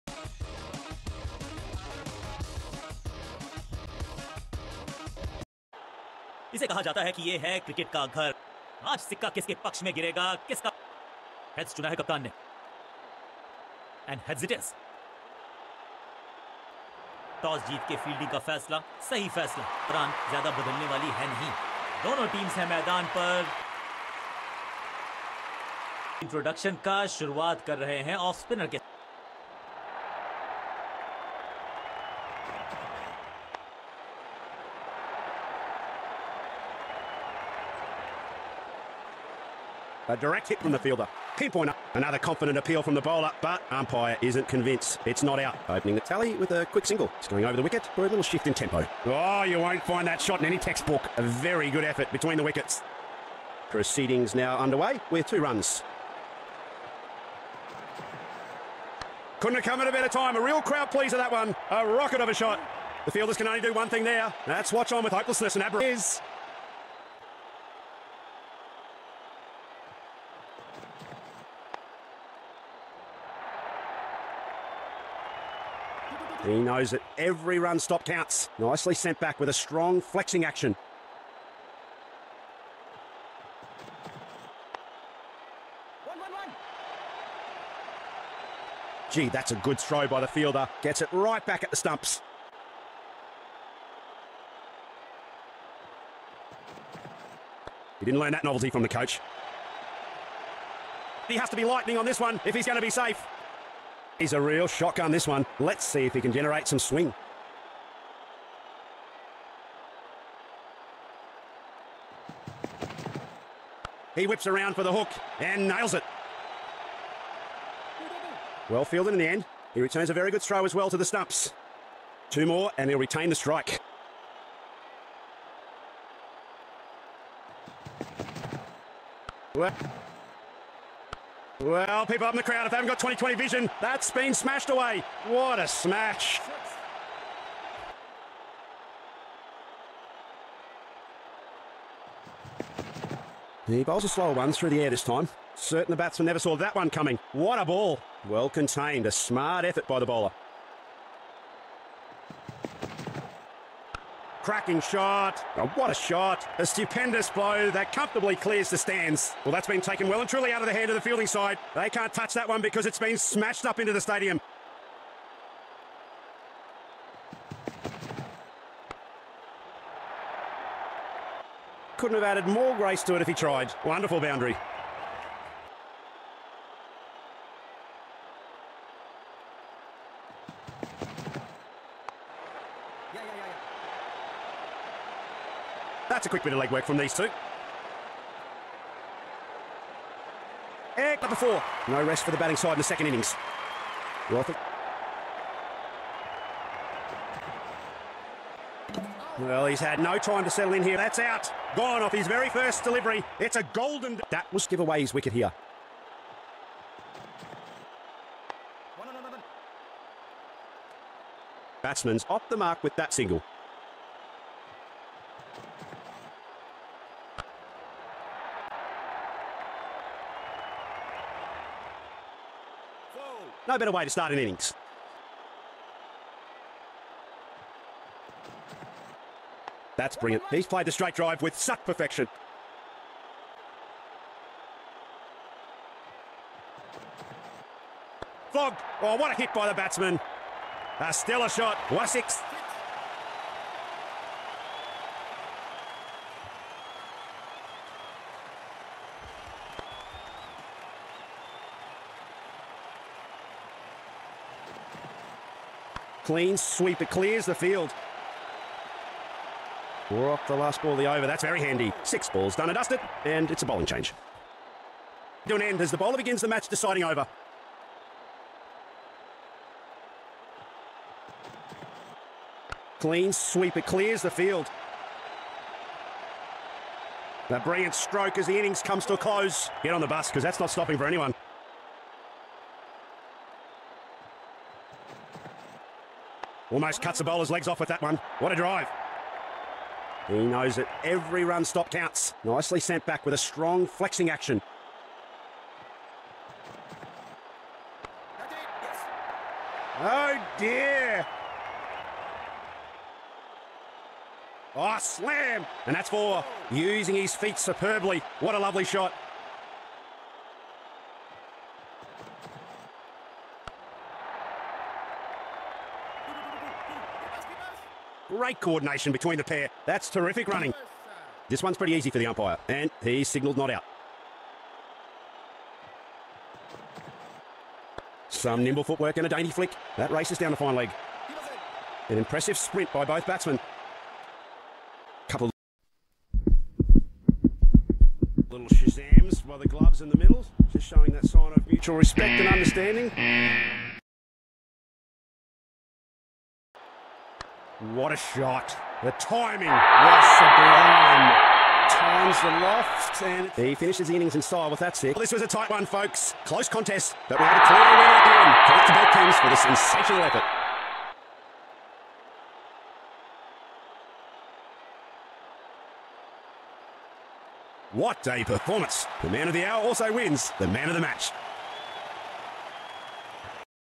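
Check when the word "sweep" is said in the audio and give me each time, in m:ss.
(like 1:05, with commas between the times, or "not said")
4:16, 4:33.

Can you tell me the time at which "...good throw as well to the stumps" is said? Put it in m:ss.
2:00.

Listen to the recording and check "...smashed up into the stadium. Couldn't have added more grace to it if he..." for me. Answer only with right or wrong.
right.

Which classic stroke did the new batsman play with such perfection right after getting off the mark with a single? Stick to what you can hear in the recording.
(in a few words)
Straight drive.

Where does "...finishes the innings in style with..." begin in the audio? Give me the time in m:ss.
5:53.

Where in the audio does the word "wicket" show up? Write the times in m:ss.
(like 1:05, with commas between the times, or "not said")
0:47, 0:52, 3:25.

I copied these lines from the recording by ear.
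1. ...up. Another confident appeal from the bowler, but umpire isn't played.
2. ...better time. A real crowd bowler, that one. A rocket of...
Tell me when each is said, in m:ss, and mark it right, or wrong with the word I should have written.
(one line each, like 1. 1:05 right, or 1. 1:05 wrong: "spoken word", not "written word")
1. 0:41 wrong: "convinced", not "played"
2. 0:59 wrong: "pleaser", not "bowler".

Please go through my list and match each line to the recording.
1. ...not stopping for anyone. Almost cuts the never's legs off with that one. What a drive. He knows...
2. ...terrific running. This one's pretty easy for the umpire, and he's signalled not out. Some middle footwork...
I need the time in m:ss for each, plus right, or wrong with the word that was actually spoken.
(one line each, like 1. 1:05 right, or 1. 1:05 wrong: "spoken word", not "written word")
1. 4:40 wrong: "bowler", not "never"
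2. 5:20 wrong: "nimble", not "middle".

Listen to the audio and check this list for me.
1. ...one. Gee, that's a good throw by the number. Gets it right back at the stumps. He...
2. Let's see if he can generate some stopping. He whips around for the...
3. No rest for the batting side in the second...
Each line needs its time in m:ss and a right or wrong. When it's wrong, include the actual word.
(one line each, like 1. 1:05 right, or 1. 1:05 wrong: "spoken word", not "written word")
1. 1:26 wrong: "fielder", not "number"
2. 1:45 wrong: "swing", not "stopping"
3. 3:11 right.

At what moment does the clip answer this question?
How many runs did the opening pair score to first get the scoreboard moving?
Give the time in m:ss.
0:55.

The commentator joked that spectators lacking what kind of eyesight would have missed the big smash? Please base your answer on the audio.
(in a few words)
20-20 vision.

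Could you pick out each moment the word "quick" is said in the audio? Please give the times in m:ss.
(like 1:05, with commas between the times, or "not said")
0:46, 3:06.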